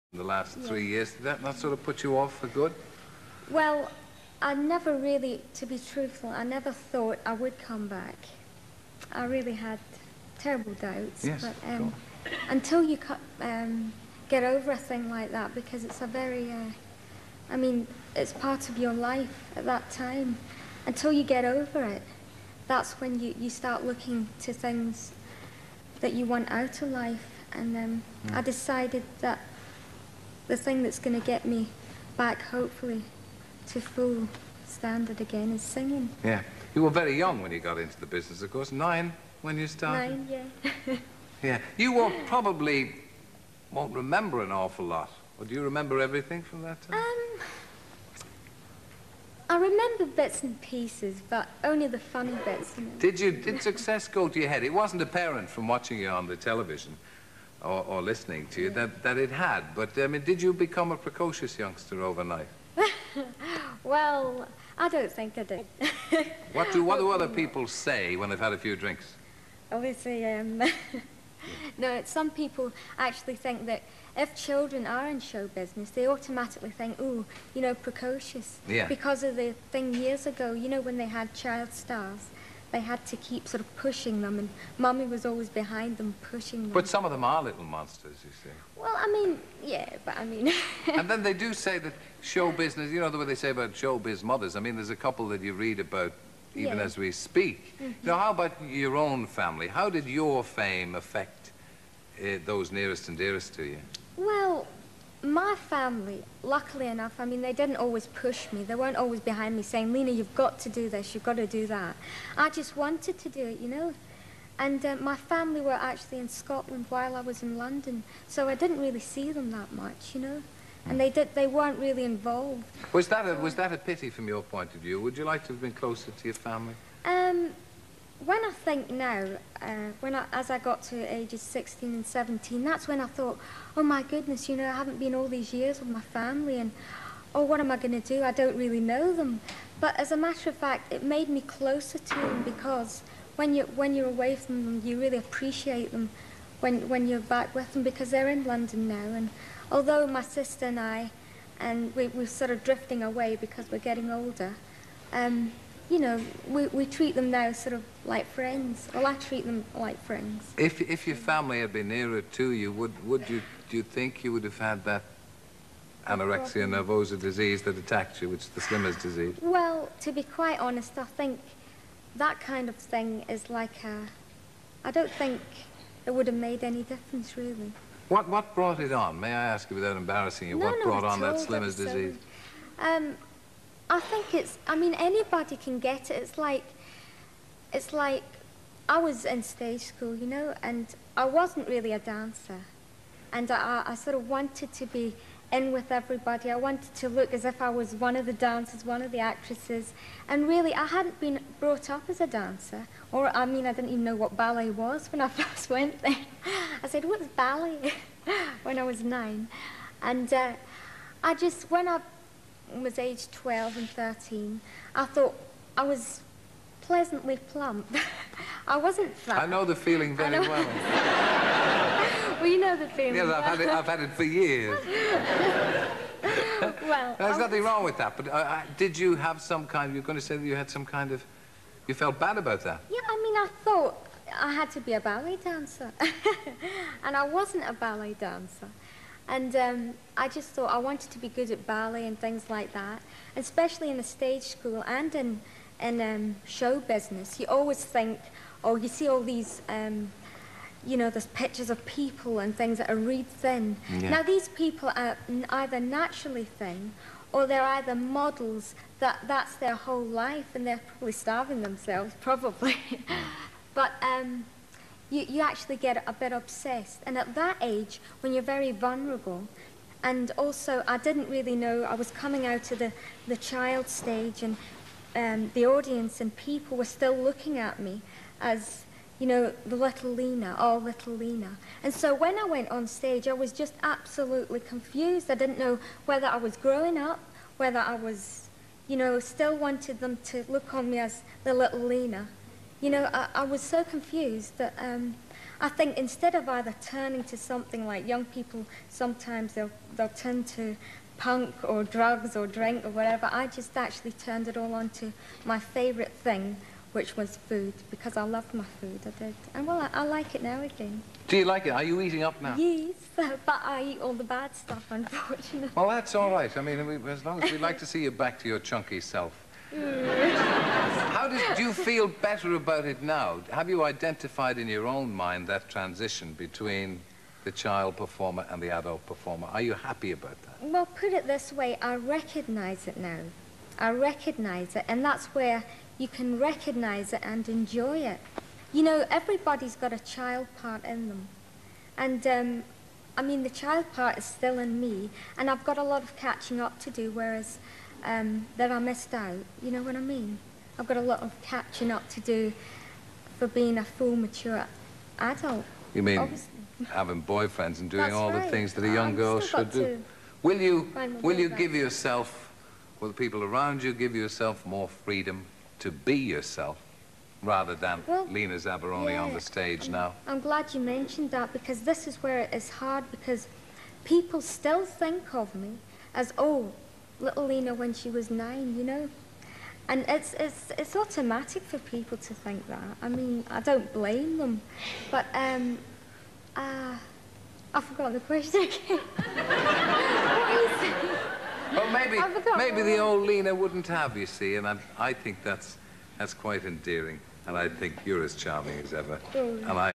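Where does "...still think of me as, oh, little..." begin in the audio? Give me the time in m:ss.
6:14.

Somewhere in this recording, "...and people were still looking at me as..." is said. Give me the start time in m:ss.
4:36.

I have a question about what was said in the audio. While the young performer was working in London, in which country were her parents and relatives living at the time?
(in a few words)
Scotland.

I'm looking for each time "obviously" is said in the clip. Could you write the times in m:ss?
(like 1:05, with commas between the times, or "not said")
1:09, 5:56.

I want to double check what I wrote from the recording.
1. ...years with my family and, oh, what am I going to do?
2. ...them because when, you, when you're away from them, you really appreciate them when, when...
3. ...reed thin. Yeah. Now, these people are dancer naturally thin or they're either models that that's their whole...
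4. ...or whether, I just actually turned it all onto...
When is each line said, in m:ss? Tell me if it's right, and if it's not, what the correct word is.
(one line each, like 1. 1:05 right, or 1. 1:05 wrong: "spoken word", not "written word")
1. 2:15 right
2. 2:22 right
3. 4:12 wrong: "either", not "dancer"
4. 5:02 wrong: "whatever", not "whether".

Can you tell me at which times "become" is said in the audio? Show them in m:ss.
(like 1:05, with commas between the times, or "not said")
1:00.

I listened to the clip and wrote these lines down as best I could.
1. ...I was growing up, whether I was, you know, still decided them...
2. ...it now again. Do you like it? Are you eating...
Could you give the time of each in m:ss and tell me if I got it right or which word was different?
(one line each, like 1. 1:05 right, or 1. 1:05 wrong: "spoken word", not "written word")
1. 4:46 wrong: "wanted", not "decided"
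2. 5:10 right.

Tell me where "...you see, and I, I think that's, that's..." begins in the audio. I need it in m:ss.
6:34.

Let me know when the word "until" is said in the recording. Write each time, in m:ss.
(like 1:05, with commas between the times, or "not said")
0:12, 0:20.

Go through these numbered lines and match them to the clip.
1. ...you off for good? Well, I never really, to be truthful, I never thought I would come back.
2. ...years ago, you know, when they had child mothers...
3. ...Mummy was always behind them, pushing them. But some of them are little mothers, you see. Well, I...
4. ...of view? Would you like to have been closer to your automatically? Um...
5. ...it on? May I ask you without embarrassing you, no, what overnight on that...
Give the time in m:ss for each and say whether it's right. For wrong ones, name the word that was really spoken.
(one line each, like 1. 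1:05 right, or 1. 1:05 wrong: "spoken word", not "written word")
1. 0:02 right
2. 1:19 wrong: "stars", not "mothers"
3. 1:24 wrong: "monsters", not "mothers"
4. 2:04 wrong: "family", not "automatically"
5. 2:58 wrong: "brought", not "overnight".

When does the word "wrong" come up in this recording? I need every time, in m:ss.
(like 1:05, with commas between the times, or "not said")
3:47.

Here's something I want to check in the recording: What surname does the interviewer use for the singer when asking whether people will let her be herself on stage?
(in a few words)
Zavaroni.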